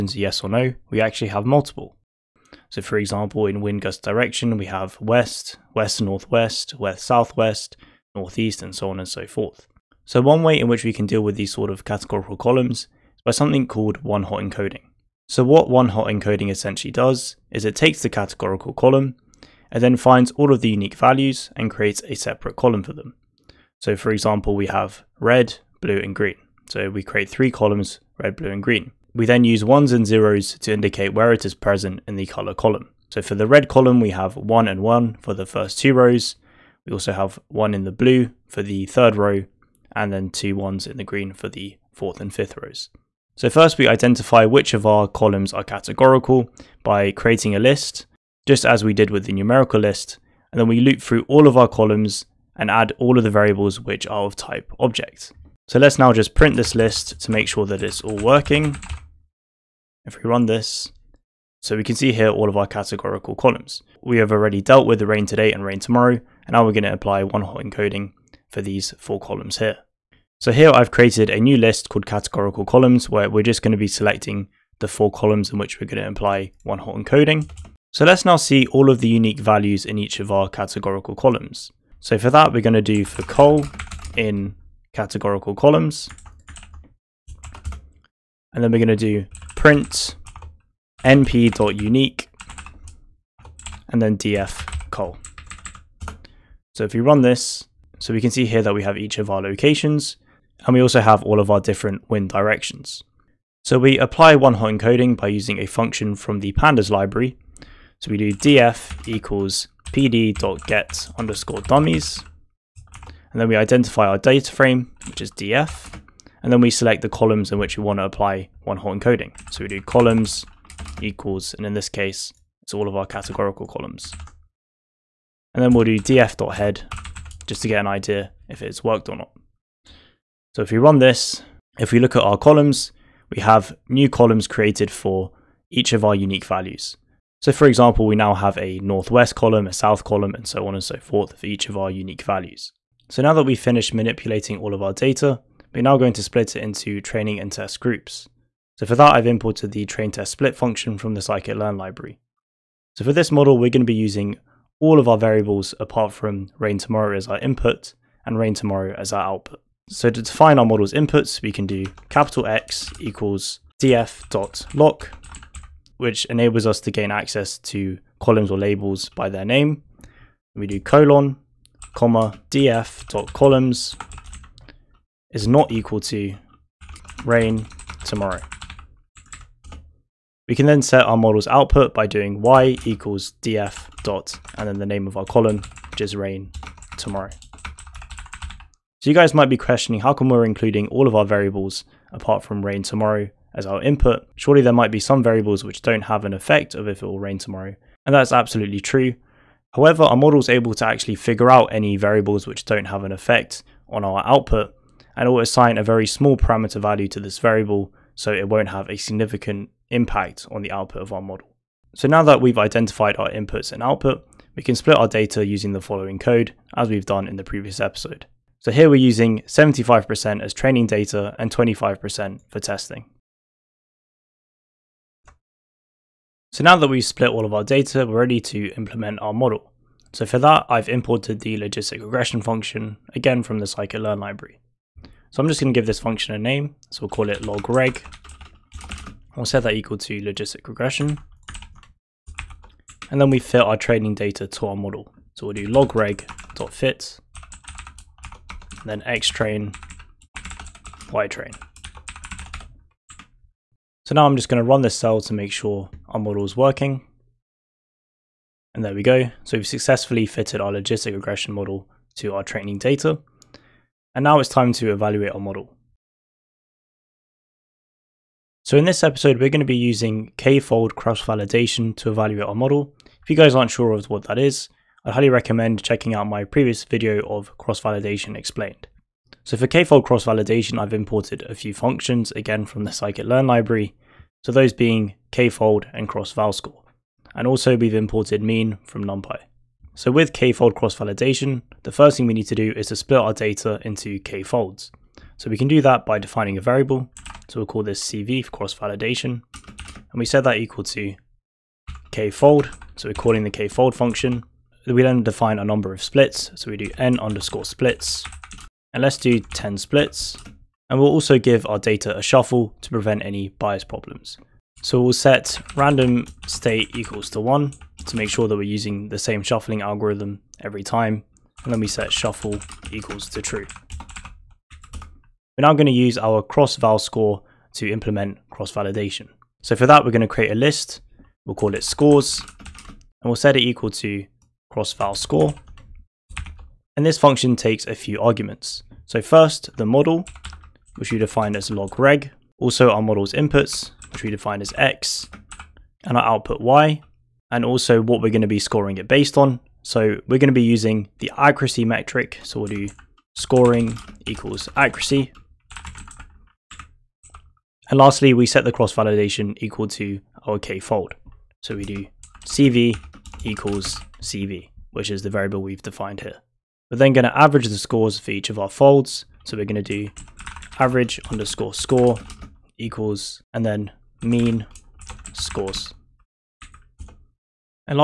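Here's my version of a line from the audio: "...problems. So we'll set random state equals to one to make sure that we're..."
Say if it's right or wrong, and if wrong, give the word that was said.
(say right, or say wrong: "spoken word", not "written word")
right.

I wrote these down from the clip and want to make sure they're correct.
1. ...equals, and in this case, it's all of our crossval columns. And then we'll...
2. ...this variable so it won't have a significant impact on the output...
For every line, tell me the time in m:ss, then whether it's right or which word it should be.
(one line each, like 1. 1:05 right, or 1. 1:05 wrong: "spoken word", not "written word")
1. 2:01 wrong: "categorical", not "crossval"
2. 3:27 right.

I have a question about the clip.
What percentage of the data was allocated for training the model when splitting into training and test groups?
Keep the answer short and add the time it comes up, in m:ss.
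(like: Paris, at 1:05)
75%, at 3:39.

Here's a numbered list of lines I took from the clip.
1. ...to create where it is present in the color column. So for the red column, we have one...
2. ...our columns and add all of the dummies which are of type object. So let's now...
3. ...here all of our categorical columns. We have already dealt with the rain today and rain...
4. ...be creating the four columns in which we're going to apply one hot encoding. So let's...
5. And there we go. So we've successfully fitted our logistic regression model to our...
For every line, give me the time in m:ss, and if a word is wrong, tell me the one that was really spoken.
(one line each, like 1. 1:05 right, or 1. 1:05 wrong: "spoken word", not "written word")
1. 0:30 wrong: "indicate", not "create"
2. 0:51 wrong: "variables", not "dummies"
3. 1:02 right
4. 1:13 wrong: "selecting", not "creating"
5. 4:18 right.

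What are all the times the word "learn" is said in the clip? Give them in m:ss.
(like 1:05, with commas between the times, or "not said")
2:31, 3:53, 4:42.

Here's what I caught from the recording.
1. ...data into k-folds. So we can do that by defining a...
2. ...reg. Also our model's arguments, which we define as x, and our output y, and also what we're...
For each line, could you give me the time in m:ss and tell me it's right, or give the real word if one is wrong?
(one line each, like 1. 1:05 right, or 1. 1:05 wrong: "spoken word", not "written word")
1. 4:53 right
2. 5:41 wrong: "inputs", not "arguments".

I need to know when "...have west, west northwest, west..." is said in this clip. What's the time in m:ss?
0:04.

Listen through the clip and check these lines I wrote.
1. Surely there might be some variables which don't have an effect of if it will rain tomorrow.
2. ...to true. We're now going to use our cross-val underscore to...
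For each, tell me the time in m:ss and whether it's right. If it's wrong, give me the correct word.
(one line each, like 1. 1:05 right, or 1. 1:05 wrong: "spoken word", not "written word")
1. 3:14 right
2. 5:23 wrong: "score", not "underscore".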